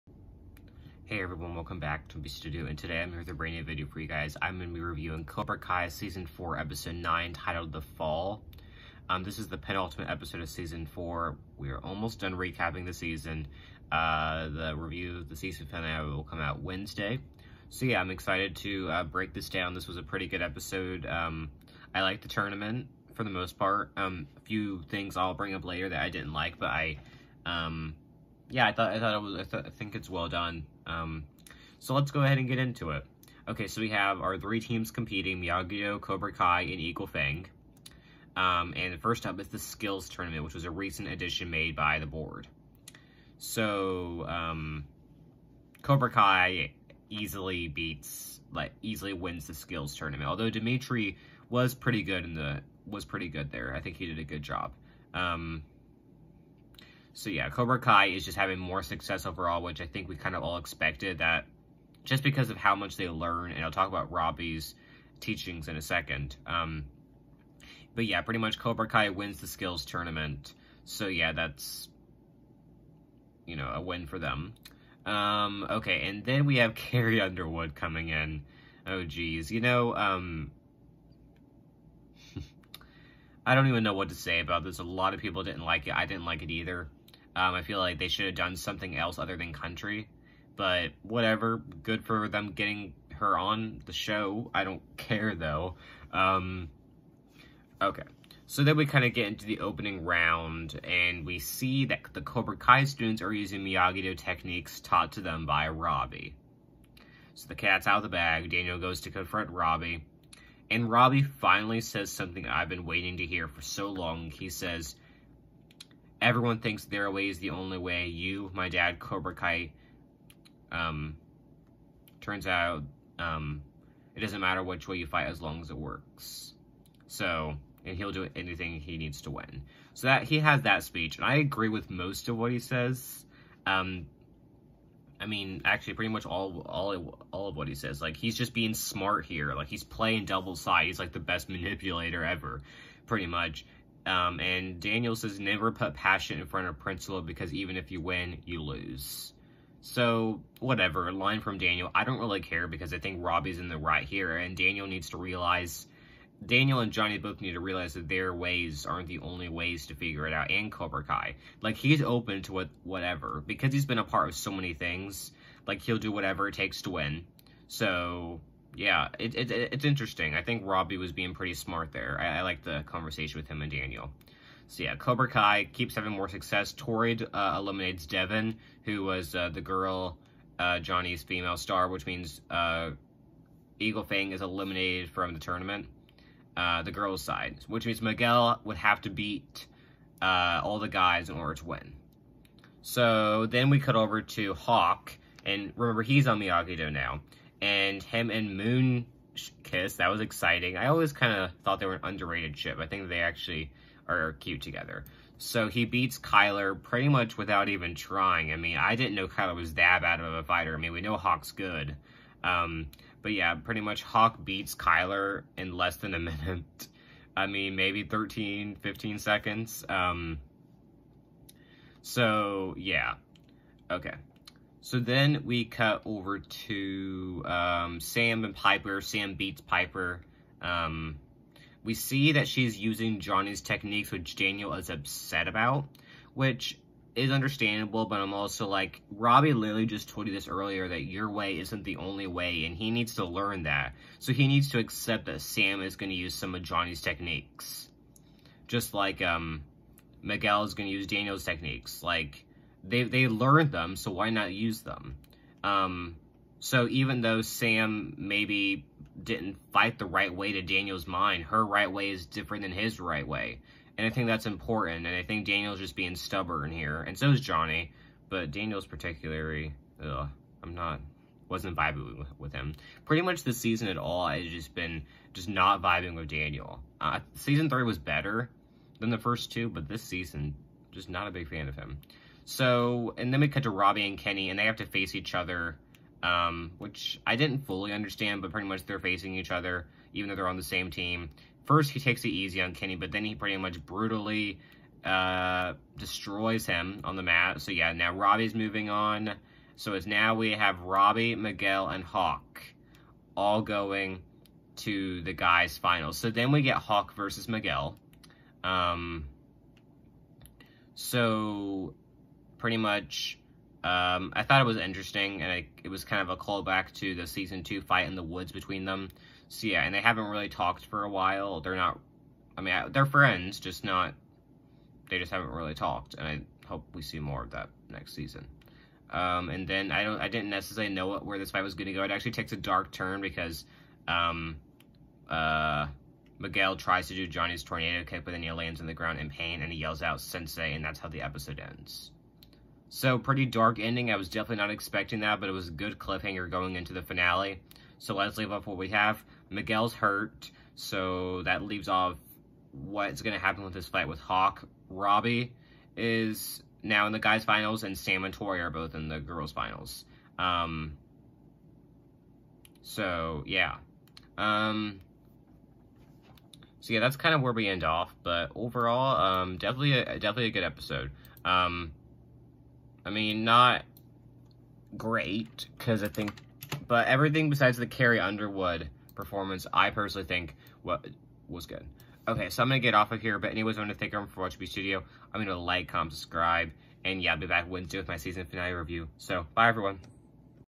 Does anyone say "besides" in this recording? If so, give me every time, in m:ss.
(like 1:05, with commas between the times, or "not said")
6:17.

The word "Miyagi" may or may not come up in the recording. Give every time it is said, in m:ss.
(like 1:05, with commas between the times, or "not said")
0:35, 1:43, 3:16.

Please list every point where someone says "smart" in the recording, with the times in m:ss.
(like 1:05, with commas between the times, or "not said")
2:18, 2:51.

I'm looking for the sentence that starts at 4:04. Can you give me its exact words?
So he needs to accept that Sam is going to use some of Johnny's techniques.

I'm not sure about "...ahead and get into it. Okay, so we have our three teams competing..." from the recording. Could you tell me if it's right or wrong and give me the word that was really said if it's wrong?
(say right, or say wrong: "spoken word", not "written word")
right.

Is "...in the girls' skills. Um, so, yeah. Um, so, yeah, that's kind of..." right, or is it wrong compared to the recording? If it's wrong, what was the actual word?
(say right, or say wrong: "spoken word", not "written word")
wrong: "finals", not "skills".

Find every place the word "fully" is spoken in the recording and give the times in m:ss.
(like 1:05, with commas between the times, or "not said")
4:47.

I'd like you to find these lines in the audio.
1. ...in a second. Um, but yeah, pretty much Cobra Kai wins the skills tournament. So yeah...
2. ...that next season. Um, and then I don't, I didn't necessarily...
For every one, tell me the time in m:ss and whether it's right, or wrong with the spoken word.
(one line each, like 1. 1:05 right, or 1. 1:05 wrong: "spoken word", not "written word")
1. 1:05 right
2. 5:27 right.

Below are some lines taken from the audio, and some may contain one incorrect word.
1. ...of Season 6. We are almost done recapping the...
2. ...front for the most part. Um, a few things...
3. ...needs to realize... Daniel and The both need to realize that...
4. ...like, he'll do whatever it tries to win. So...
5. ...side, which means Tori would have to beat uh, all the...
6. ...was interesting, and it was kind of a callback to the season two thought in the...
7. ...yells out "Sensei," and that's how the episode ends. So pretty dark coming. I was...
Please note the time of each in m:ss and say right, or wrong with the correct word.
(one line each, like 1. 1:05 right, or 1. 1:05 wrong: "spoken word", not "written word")
1. 0:10 wrong: "4", not "6"
2. 0:22 wrong: "tournament", not "front"
3. 2:34 wrong: "Johnny", not "The"
4. 2:45 wrong: "takes", not "tries"
5. 3:07 wrong: "Miguel", not "Tori"
6. 5:14 wrong: "fight", not "thought"
7. 5:39 wrong: "ending", not "coming".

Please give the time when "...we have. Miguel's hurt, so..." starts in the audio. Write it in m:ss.
5:48.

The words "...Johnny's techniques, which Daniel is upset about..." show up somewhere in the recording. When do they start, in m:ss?
3:53.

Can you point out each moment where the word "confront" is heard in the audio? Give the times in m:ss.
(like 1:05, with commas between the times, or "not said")
1:49.